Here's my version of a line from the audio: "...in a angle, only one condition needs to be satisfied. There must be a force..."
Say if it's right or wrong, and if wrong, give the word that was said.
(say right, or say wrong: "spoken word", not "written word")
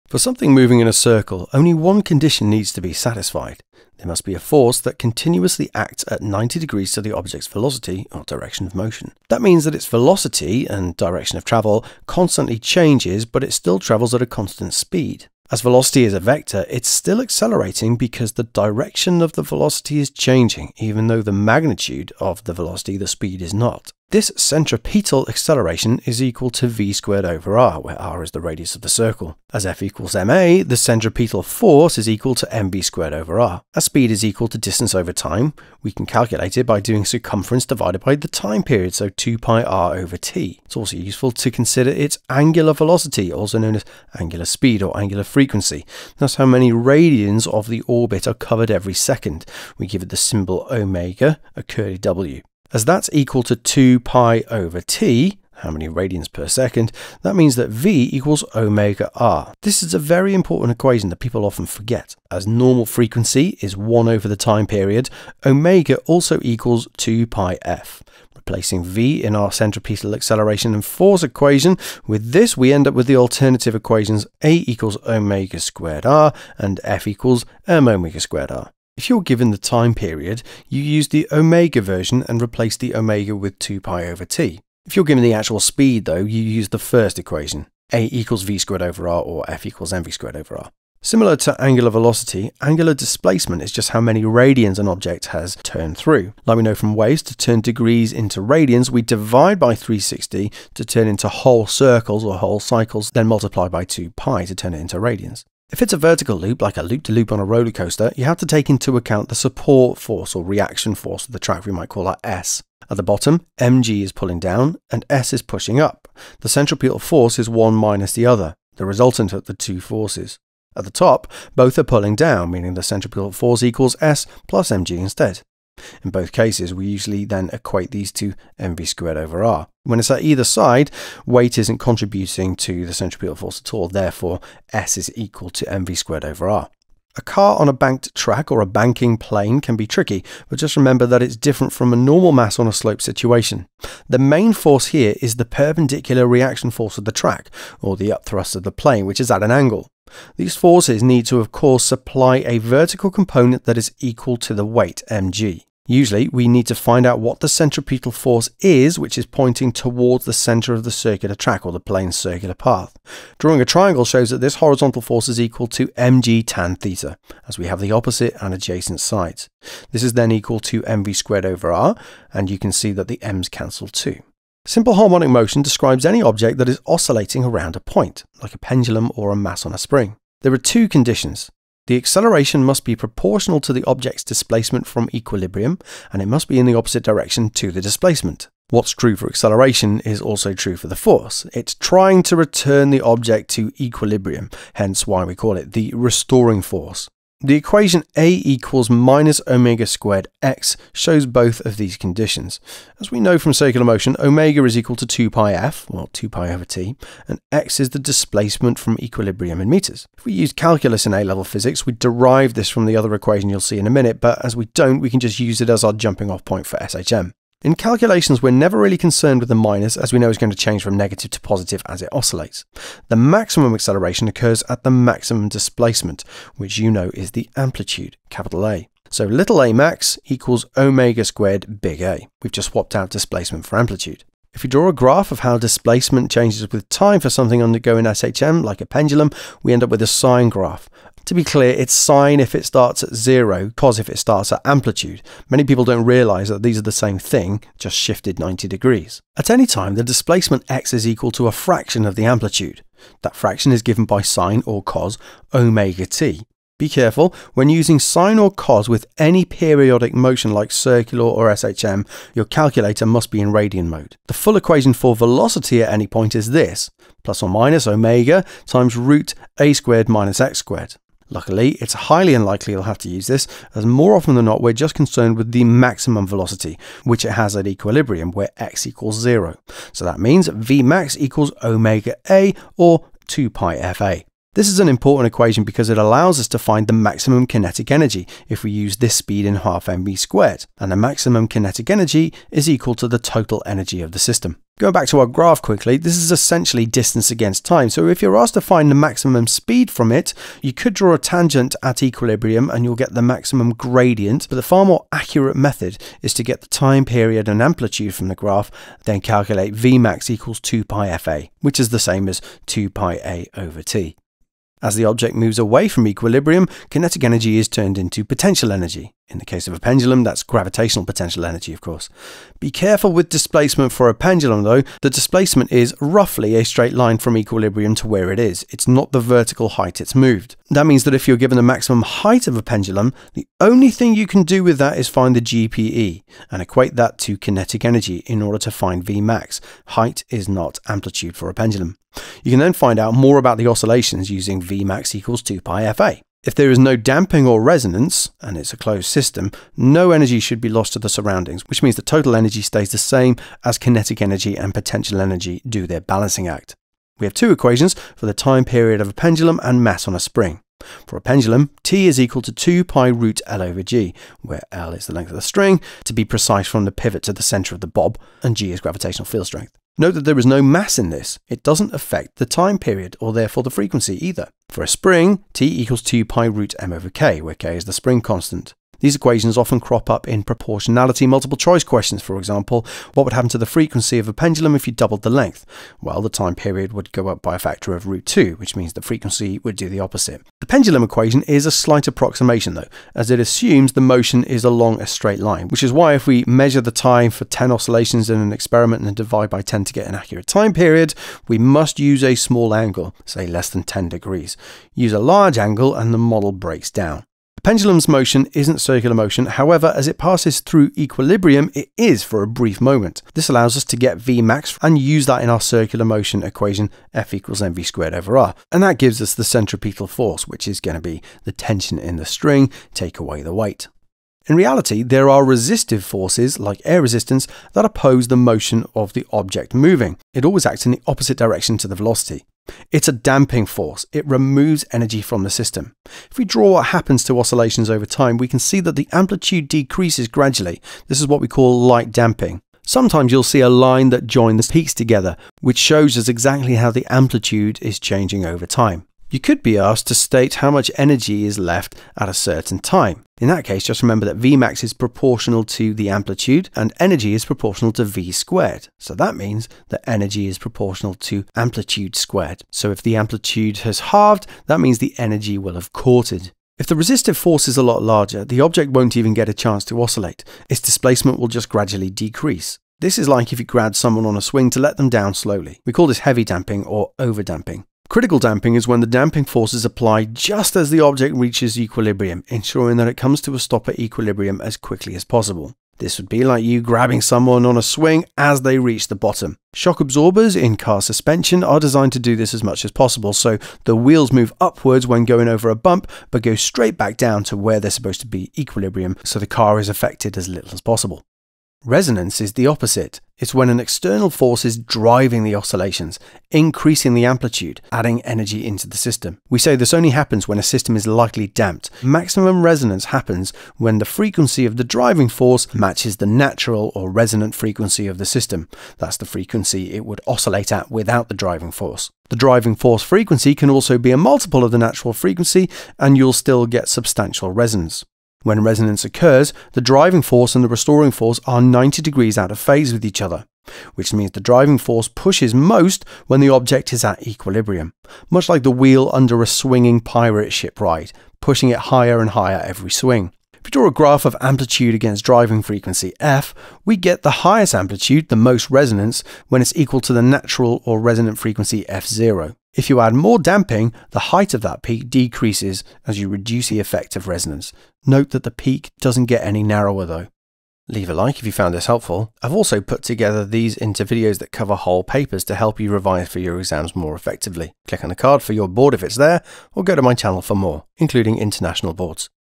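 wrong: "circle", not "angle".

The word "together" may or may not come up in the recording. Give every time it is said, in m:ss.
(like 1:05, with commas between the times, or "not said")
7:24, 9:23.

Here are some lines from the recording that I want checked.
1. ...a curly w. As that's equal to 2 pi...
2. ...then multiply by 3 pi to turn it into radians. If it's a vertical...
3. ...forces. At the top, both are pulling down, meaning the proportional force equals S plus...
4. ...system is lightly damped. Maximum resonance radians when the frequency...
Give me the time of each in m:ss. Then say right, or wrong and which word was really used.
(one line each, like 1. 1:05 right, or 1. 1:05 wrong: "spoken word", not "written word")
1. 0:51 right
2. 1:43 wrong: "2", not "3"
3. 1:59 wrong: "centripetal", not "proportional"
4. 8:30 wrong: "happens", not "radians".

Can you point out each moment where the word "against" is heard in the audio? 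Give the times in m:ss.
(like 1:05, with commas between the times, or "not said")
4:57, 9:04.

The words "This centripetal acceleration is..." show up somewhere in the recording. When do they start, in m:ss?
0:24.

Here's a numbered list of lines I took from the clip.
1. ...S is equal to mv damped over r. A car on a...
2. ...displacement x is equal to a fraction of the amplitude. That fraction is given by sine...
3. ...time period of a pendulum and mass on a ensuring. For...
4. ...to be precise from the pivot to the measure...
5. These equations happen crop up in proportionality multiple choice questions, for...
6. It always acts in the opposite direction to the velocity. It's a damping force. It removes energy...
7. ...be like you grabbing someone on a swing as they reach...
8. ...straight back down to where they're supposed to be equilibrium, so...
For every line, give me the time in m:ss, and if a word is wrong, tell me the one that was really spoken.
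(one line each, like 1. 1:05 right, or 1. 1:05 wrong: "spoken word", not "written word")
1. 2:14 wrong: "squared", not "damped"
2. 4:10 right
3. 5:58 wrong: "spring", not "ensuring"
4. 6:06 wrong: "centre", not "measure"
5. 6:19 wrong: "often", not "happen"
6. 7:10 right
7. 8:06 right
8. 8:16 right.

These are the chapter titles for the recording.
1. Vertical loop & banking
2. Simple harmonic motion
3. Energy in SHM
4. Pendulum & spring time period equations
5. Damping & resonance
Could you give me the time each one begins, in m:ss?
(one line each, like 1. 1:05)
1. 1:45
2. 2:53
3. 5:13
4. 5:56
5. 7:03.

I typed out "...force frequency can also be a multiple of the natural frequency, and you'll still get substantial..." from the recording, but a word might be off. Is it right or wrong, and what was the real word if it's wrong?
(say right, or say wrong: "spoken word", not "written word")
right.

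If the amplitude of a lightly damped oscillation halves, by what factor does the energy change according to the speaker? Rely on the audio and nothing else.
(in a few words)
quartered.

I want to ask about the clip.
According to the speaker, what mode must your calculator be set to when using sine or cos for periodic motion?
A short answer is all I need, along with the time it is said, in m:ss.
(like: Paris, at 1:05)
radian mode, at 4:23.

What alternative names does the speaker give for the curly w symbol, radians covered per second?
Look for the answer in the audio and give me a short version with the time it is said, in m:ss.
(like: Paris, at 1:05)
angular speed or angular frequency, at 0:44.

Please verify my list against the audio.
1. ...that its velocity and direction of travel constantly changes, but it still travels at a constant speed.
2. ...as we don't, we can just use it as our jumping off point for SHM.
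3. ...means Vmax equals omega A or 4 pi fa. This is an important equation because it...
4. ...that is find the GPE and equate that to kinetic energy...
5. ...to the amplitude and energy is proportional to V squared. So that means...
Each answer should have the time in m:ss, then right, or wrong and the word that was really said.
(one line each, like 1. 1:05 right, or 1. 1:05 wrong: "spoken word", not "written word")
1. 0:09 right
2. 3:34 right
3. 4:40 wrong: "2", not "4"
4. 5:34 right
5. 7:35 right.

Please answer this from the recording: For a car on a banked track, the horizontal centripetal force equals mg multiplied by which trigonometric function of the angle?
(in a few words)
tan theta.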